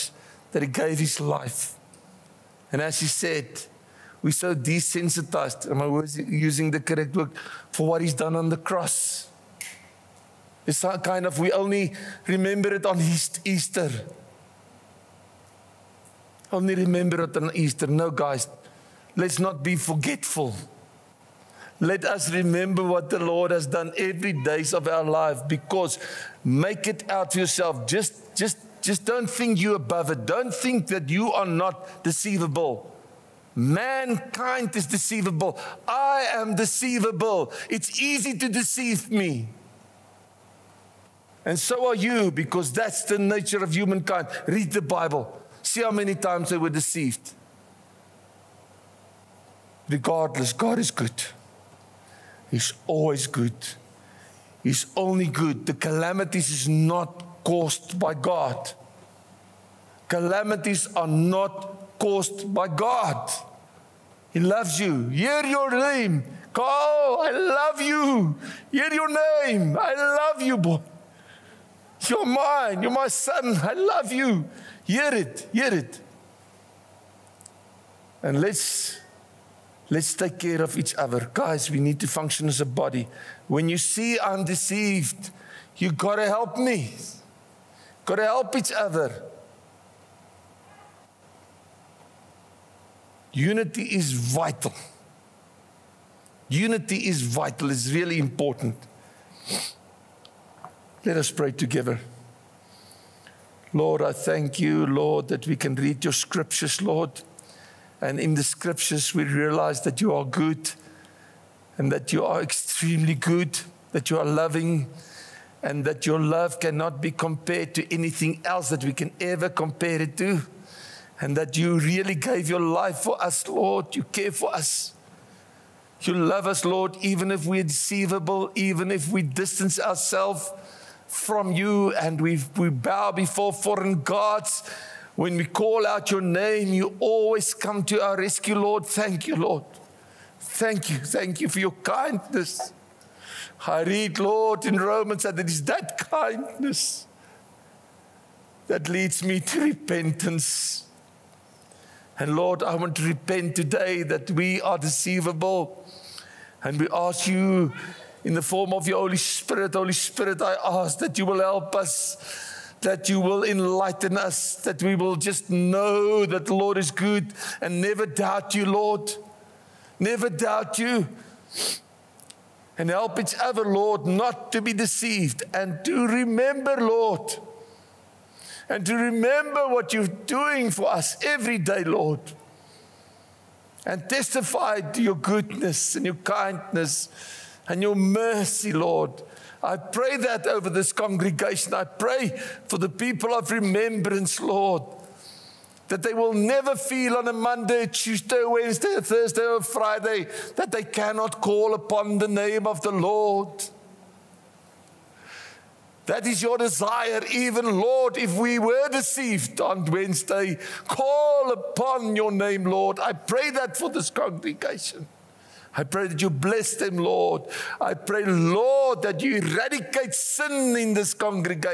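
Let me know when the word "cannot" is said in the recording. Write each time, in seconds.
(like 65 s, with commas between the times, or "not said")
116 s, 200 s.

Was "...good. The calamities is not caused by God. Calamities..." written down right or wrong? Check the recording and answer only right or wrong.
right.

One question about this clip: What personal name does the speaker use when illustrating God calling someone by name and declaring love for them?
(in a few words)
Carl.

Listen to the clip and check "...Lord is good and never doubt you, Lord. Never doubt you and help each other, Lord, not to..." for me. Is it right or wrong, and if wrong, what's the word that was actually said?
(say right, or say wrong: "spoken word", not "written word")
right.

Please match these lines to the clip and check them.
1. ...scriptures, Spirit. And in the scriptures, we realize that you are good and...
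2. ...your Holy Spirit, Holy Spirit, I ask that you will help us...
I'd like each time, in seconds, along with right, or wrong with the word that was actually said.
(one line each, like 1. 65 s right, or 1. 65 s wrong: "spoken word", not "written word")
1. 106 s wrong: "Lord", not "Spirit"
2. 158 s right.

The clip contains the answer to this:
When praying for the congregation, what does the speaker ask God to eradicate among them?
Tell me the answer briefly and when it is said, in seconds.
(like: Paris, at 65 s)
Sin, at 220 s.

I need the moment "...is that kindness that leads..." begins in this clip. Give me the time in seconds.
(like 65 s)
145 s.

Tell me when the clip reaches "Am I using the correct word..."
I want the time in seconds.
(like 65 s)
5 s.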